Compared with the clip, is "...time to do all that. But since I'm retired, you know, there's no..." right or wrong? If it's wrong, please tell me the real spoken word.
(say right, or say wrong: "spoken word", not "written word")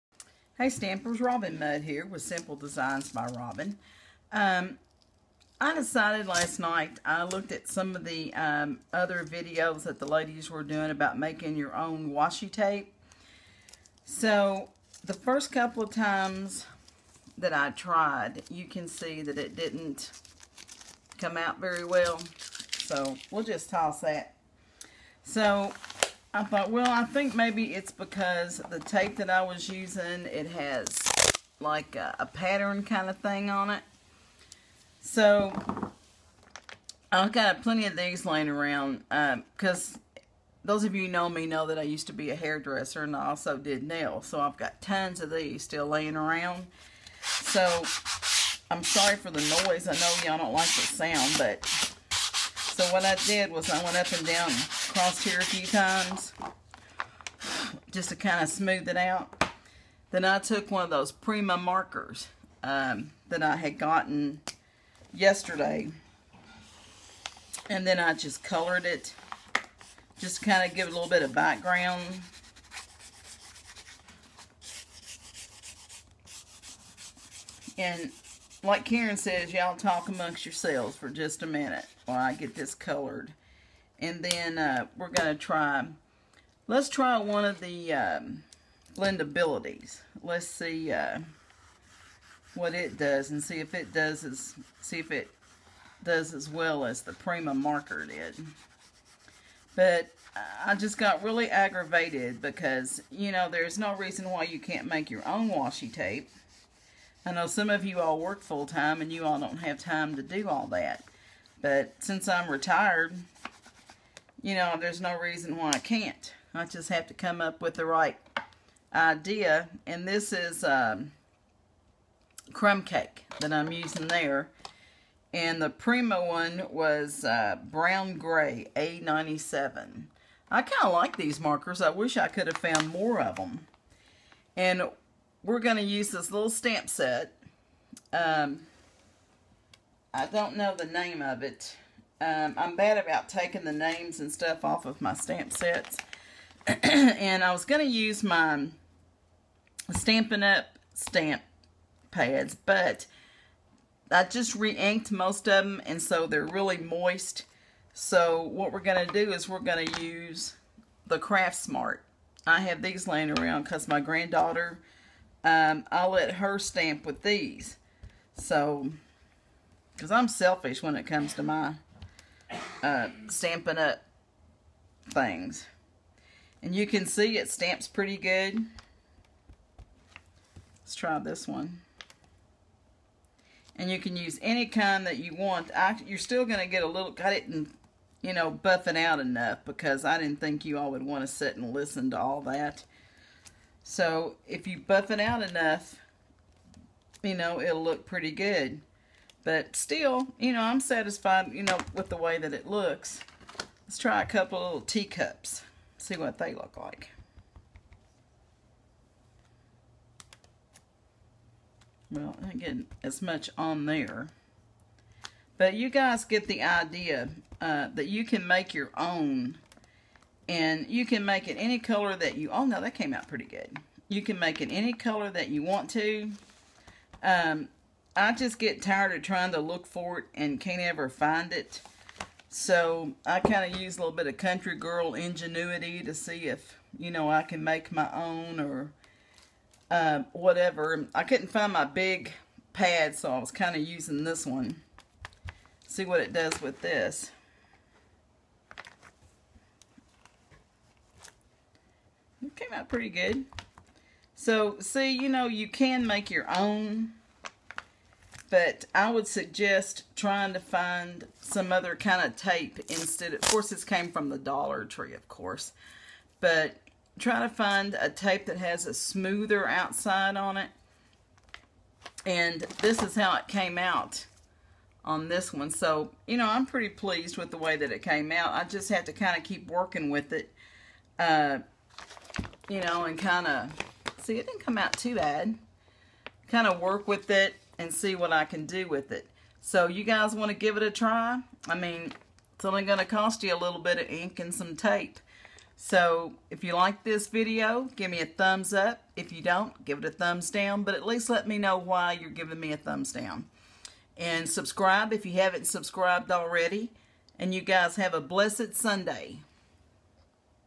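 right.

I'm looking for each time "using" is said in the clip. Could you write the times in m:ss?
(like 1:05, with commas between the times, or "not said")
0:29, 2:03, 4:03.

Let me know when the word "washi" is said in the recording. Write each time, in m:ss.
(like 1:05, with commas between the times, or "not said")
0:12, 1:45.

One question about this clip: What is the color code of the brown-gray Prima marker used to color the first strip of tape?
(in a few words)
A97.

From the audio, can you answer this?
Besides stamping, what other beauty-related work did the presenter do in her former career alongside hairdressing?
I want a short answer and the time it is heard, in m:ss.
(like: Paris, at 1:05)
Nails, at 0:43.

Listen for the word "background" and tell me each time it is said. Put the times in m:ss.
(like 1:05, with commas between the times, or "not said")
1:11.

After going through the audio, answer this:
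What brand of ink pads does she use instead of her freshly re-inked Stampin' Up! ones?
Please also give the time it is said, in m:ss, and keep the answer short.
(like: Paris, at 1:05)
Craft Smart, at 2:41.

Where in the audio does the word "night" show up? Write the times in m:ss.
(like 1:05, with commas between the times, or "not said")
0:06.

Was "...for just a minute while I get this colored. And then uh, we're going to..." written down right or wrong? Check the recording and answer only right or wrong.
right.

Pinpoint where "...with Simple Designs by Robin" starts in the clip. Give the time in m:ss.
0:02.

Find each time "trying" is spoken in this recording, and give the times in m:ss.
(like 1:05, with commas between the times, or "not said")
3:49, 4:20.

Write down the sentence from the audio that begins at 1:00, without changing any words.
Then I took one of those Prima markers um, that I had gotten yesterday.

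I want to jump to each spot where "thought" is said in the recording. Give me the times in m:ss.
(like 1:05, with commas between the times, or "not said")
0:26.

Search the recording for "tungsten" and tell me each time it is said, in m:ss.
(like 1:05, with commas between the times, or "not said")
not said.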